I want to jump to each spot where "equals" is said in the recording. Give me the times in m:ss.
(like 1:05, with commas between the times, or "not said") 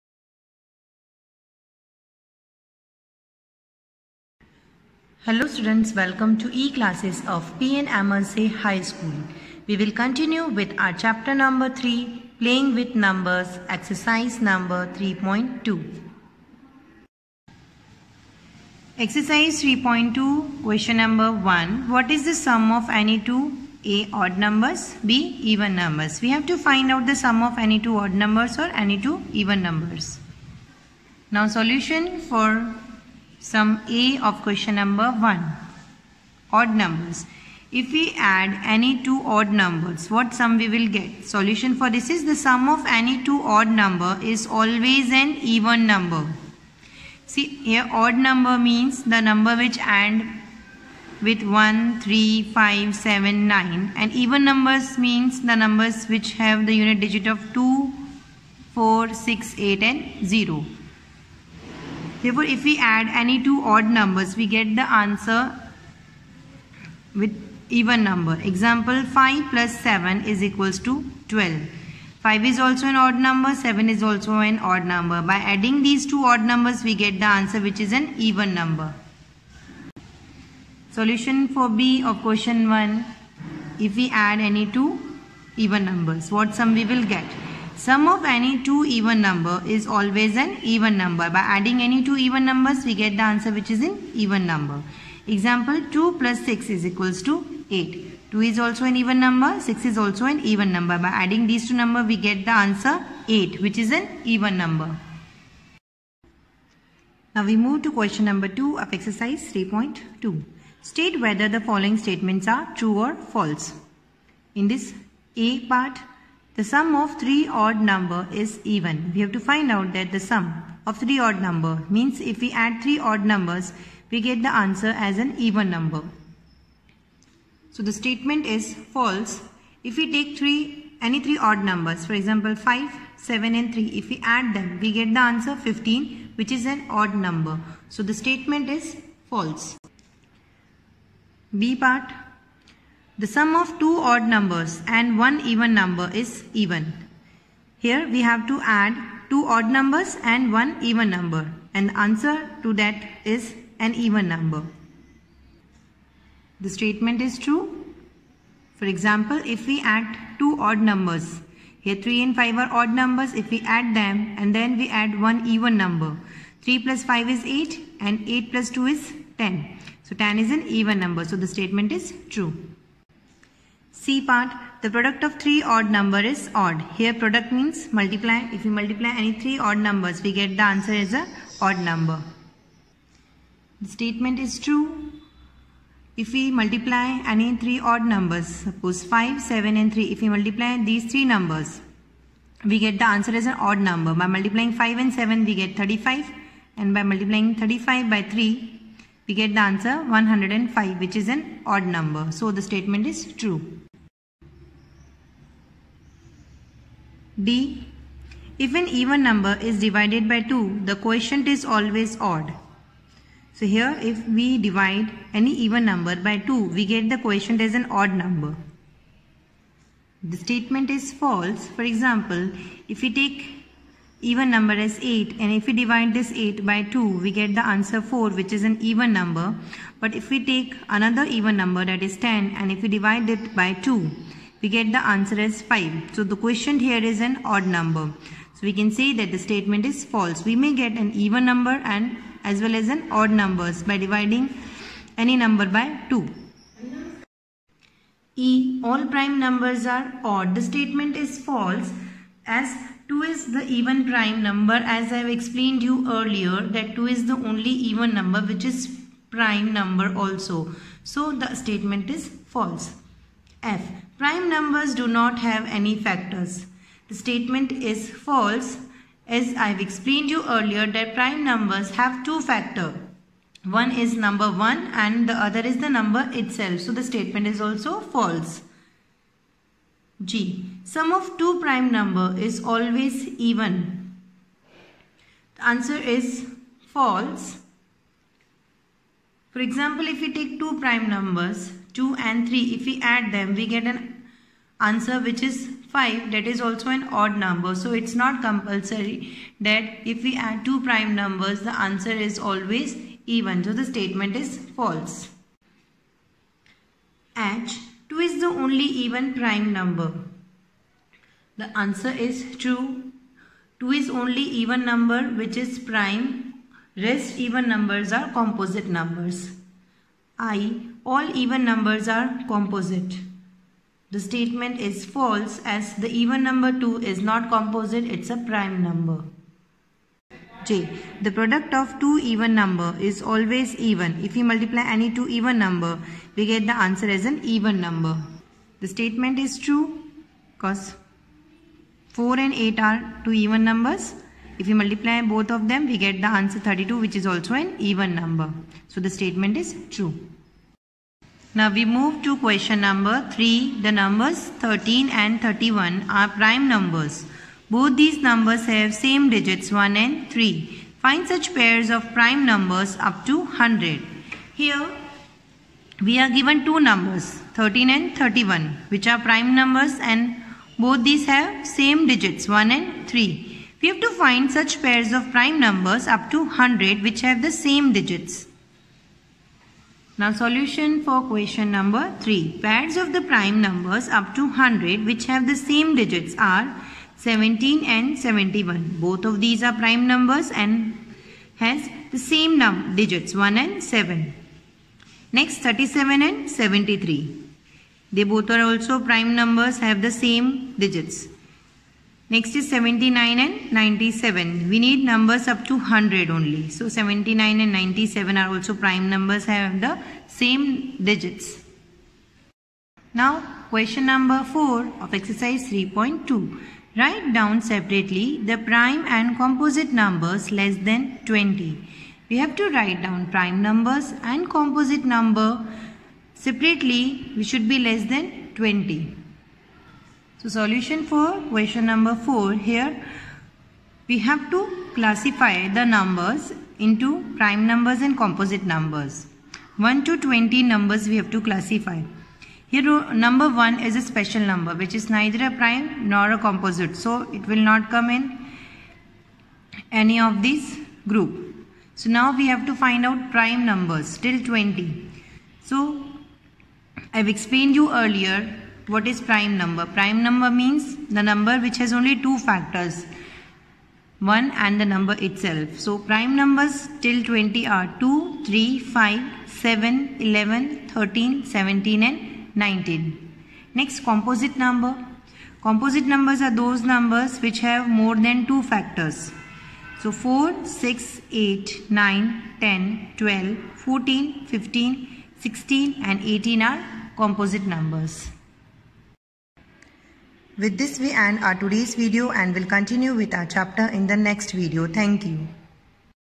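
1:10, 1:36.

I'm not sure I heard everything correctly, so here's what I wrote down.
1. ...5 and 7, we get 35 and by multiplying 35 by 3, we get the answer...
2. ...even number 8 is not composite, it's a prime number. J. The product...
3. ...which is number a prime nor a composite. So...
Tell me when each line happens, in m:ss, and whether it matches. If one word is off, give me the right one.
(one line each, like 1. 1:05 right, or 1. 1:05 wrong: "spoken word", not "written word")
1. 3:14 right
2. 5:26 wrong: "2", not "8"
3. 7:24 wrong: "neither", not "number".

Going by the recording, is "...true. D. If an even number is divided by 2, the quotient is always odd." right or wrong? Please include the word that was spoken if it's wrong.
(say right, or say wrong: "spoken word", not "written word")
right.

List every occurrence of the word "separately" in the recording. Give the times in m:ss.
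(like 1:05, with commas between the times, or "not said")
6:57, 7:06.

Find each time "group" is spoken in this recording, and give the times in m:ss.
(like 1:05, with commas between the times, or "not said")
7:31.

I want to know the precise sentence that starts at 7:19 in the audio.
1 to 20 numbers we have to classify.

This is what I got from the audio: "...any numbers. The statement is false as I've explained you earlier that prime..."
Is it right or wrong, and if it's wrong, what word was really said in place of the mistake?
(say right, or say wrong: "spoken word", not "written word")
wrong: "factors", not "numbers".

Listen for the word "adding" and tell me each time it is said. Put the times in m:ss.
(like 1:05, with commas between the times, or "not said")
1:15, 1:31, 1:41.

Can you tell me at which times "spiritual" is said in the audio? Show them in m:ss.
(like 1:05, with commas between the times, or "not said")
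not said.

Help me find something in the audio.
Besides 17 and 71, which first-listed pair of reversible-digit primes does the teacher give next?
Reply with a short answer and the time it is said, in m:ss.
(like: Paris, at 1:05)
37 and 73, at 6:35.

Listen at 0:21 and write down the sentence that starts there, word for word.
What is the sum of any two A odd numbers, B even numbers?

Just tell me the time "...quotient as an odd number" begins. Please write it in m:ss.
3:37.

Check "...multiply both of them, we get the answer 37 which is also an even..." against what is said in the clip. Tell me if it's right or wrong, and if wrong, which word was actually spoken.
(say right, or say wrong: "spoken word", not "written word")
wrong: "32", not "37".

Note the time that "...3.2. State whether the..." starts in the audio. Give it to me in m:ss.
1:49.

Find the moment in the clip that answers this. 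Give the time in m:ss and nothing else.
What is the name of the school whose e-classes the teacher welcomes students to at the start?
0:07.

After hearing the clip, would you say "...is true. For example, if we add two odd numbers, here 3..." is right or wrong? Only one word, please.
right.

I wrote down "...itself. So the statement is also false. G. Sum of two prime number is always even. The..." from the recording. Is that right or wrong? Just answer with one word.
right.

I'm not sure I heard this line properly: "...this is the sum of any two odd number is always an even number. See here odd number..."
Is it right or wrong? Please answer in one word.
right.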